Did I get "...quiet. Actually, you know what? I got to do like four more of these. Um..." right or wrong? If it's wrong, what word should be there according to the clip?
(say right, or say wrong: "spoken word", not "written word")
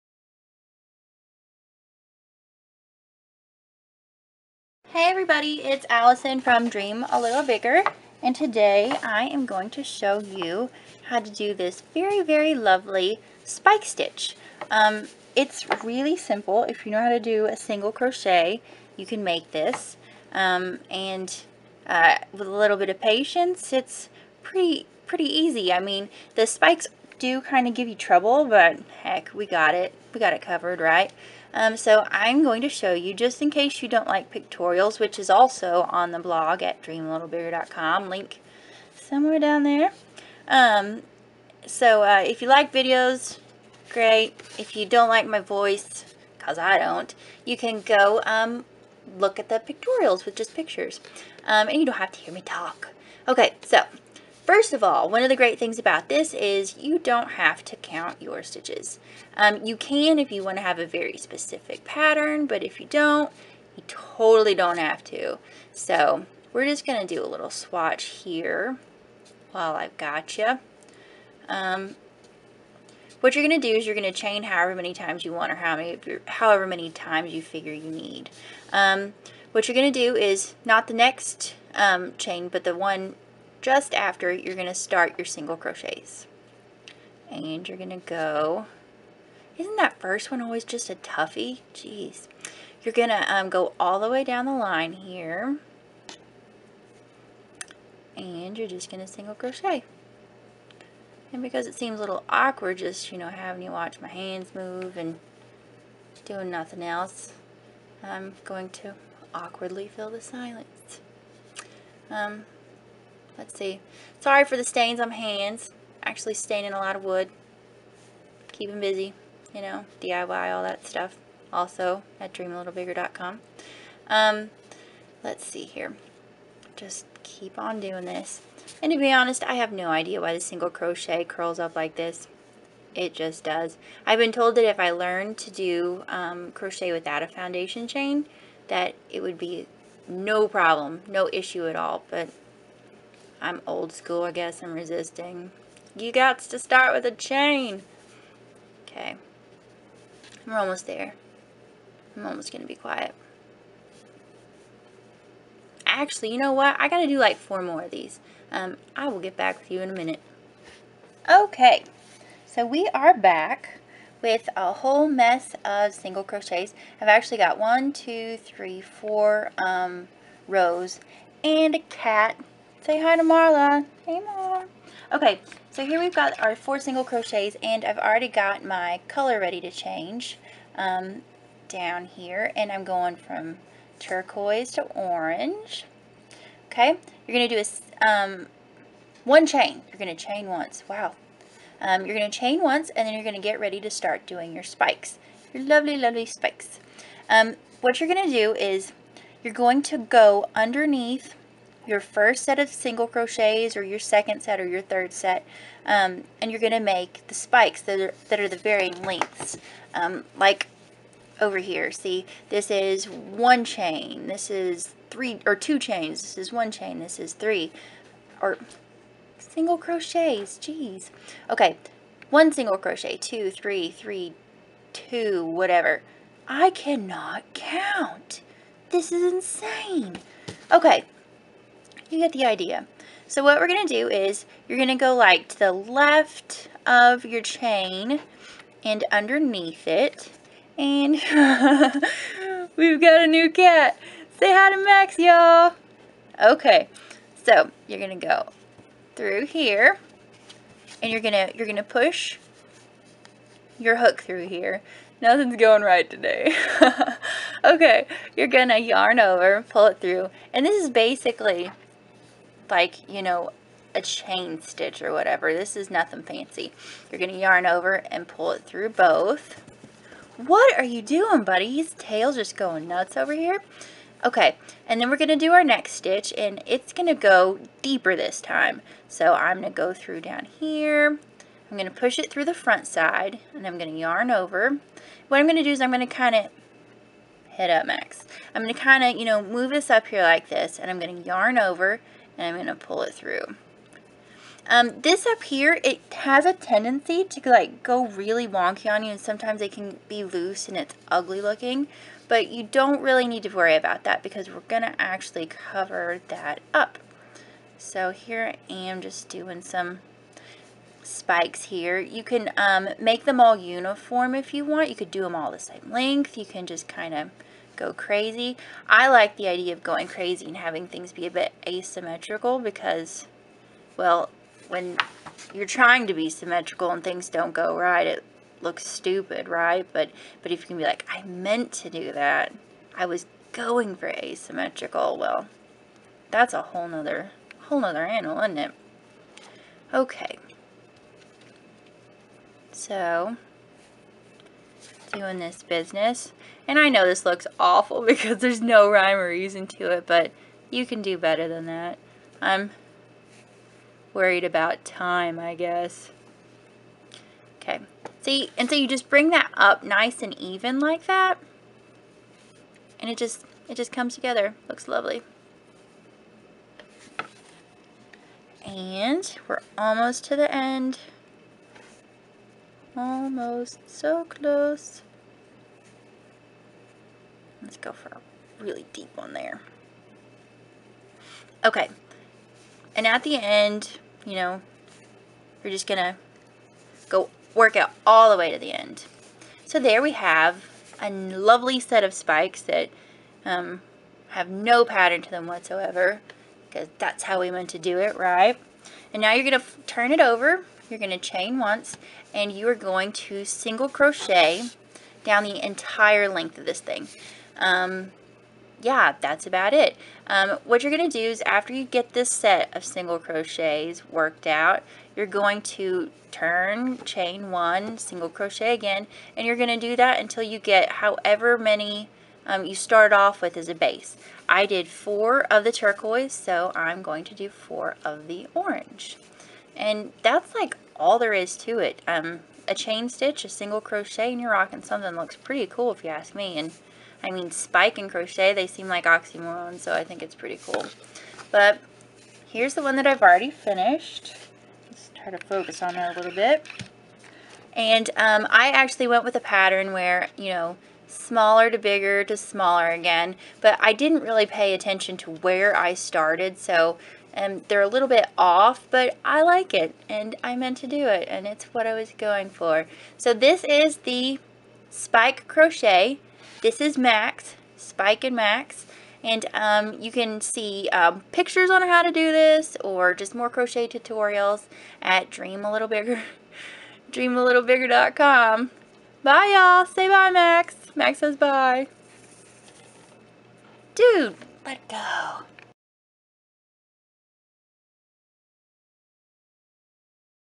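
right.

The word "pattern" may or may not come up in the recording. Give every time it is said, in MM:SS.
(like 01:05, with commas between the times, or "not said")
01:01, 06:34, 07:29.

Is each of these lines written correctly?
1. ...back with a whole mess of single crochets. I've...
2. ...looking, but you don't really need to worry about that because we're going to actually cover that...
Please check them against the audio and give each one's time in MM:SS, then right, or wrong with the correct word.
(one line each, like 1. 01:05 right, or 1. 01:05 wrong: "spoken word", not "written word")
1. 02:43 right
2. 05:01 right.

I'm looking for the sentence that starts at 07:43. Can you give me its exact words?
So this is the spike crochet this is Max, Spike and Max.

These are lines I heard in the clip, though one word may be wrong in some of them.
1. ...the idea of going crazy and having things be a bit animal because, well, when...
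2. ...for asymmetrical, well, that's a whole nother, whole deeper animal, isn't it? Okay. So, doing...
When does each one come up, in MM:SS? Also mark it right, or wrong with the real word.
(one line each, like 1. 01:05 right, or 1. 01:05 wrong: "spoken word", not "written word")
1. 05:19 wrong: "asymmetrical", not "animal"
2. 05:33 wrong: "nother", not "deeper".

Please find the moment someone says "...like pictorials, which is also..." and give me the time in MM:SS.
00:34.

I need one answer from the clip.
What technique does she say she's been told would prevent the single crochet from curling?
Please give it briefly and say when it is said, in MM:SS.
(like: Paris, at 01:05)
Crochet without a foundation chain, at 02:16.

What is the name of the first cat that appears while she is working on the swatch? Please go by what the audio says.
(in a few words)
Marla.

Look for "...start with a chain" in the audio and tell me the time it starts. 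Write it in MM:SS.
02:26.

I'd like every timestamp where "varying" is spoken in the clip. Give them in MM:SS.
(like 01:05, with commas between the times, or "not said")
03:28.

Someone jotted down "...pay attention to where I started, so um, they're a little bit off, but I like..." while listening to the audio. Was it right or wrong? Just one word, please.
right.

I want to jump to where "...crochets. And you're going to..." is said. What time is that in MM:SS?
01:25.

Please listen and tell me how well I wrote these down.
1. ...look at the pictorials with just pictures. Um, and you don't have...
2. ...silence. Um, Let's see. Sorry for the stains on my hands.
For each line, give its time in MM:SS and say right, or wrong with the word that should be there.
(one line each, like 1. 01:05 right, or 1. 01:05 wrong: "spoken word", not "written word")
1. 00:49 right
2. 01:50 right.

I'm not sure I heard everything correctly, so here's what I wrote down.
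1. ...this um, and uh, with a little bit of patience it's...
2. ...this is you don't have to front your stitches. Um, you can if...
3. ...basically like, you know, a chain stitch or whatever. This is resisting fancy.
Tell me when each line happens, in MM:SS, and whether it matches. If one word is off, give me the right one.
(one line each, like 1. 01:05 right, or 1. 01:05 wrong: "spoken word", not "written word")
1. 00:19 right
2. 00:56 wrong: "count", not "front"
3. 04:20 wrong: "nothing", not "resisting".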